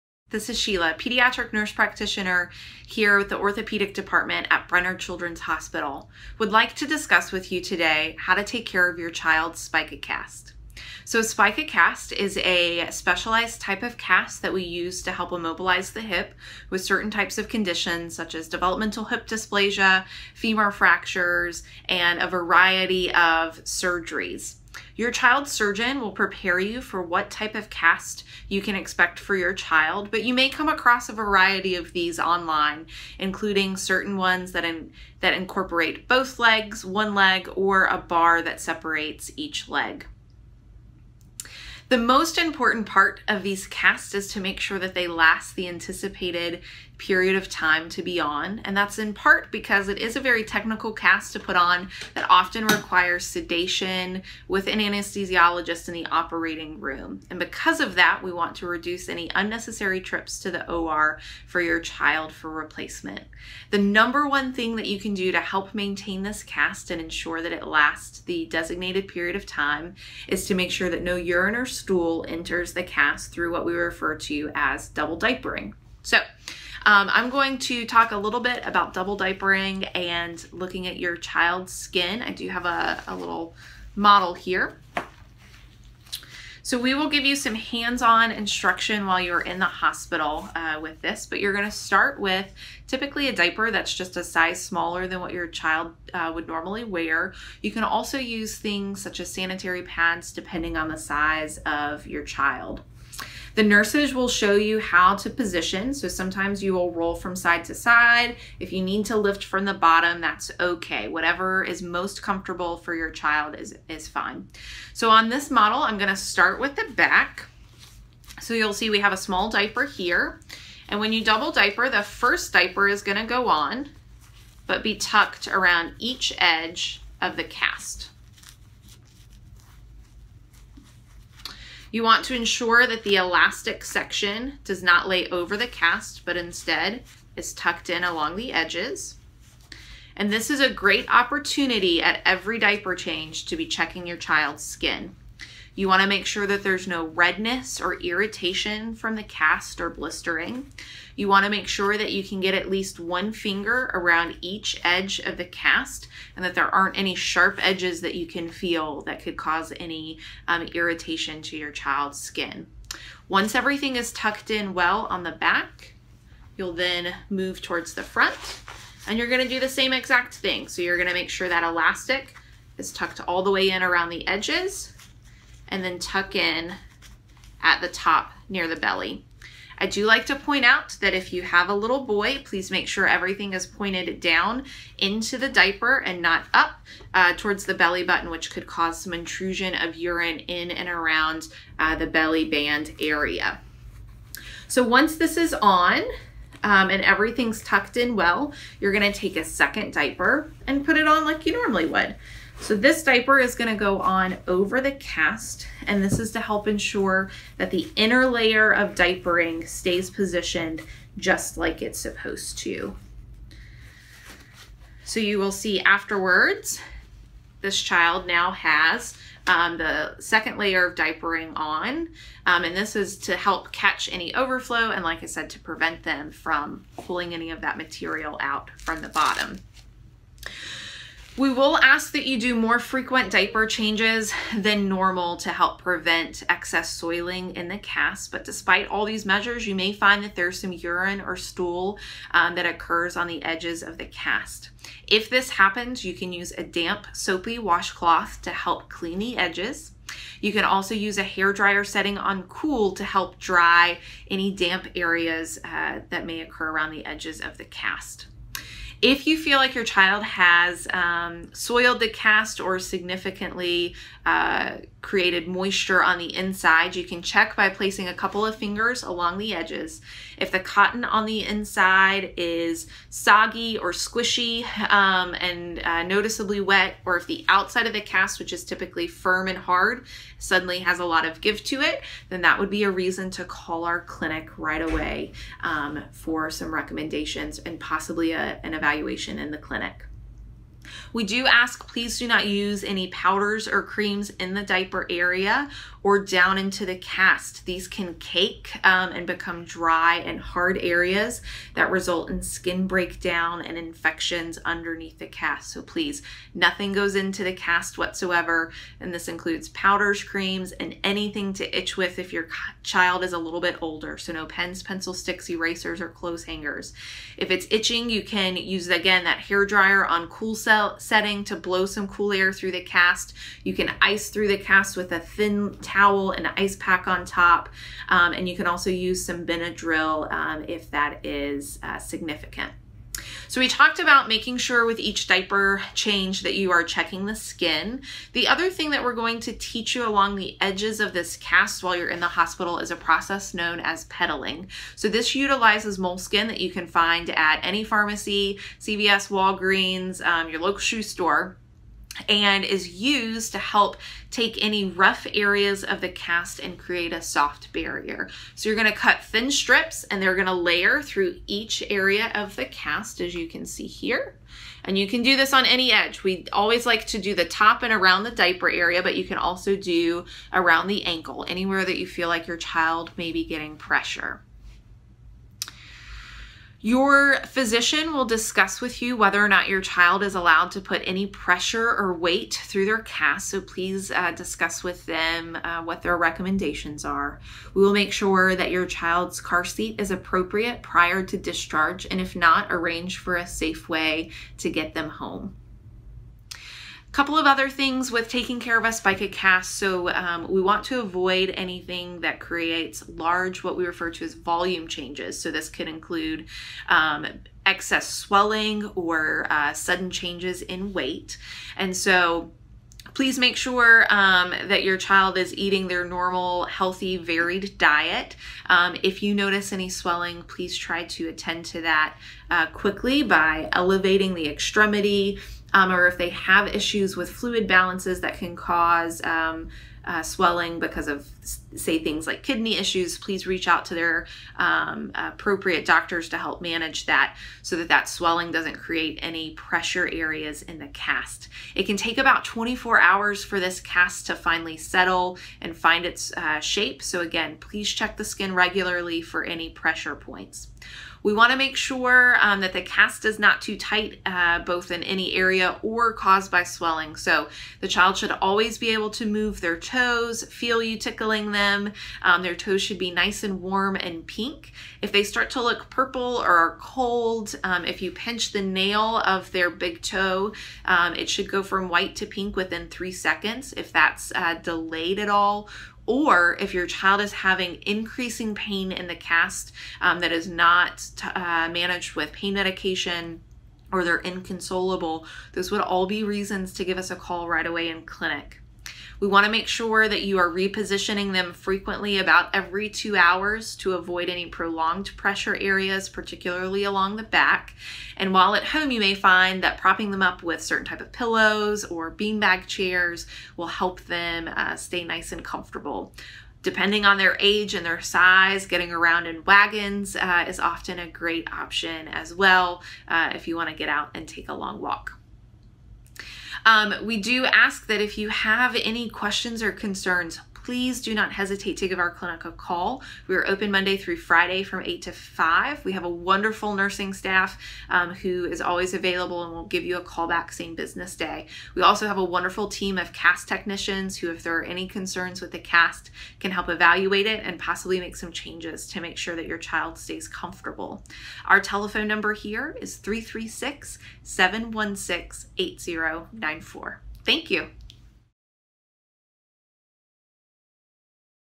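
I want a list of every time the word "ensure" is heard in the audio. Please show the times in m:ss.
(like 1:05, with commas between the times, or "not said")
1:07, 2:12, 3:26.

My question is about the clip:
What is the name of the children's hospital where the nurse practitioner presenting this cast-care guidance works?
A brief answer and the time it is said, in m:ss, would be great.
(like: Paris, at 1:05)
Brenner Children's Hospital, at 0:04.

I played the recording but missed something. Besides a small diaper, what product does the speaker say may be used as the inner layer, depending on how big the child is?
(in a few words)
Sanitary pads.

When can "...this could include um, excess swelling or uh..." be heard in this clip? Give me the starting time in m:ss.
6:45.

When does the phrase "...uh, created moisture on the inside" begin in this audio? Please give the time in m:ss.
4:24.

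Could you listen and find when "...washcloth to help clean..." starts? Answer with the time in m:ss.
4:07.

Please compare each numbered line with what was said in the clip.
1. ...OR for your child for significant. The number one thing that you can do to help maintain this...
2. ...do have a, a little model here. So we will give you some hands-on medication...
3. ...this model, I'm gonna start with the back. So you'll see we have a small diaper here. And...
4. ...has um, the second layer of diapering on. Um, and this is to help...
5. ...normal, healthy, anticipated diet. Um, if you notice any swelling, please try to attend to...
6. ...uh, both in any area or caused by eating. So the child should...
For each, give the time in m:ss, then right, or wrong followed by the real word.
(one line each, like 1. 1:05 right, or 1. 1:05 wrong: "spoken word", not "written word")
1. 1:00 wrong: "replacement", not "significant"
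2. 1:22 wrong: "instruction", not "medication"
3. 1:55 right
4. 3:38 right
5. 6:56 wrong: "varied", not "anticipated"
6. 7:34 wrong: "swelling", not "eating".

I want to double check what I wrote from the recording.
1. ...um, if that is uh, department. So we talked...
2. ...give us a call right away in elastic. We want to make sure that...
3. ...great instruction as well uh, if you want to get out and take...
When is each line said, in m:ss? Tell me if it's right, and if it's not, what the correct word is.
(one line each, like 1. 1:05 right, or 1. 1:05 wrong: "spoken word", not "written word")
1. 5:30 wrong: "significant", not "department"
2. 8:06 wrong: "clinic", not "elastic"
3. 8:31 wrong: "option", not "instruction".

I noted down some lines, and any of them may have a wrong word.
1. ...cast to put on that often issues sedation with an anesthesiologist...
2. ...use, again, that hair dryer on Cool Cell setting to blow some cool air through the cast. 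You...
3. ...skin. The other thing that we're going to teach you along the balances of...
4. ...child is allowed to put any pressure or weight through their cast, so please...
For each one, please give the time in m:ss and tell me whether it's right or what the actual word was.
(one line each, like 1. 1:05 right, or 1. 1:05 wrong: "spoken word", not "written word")
1. 0:50 wrong: "requires", not "issues"
2. 5:18 right
3. 5:37 wrong: "edges", not "balances"
4. 6:19 right.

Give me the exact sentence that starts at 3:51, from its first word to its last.
We will ask that you do more frequent diaper changes than normal to help prevent excess soiling in the cast.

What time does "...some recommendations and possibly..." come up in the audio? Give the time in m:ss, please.
4:46.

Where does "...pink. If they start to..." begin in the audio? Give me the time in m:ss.
7:44.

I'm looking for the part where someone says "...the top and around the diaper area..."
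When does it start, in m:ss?
6:07.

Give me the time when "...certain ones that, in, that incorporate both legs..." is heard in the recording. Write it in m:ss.
0:33.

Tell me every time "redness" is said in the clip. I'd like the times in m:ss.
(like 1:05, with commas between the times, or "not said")
2:27.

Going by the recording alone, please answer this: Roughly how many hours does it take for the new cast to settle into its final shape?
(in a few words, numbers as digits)
24 hours.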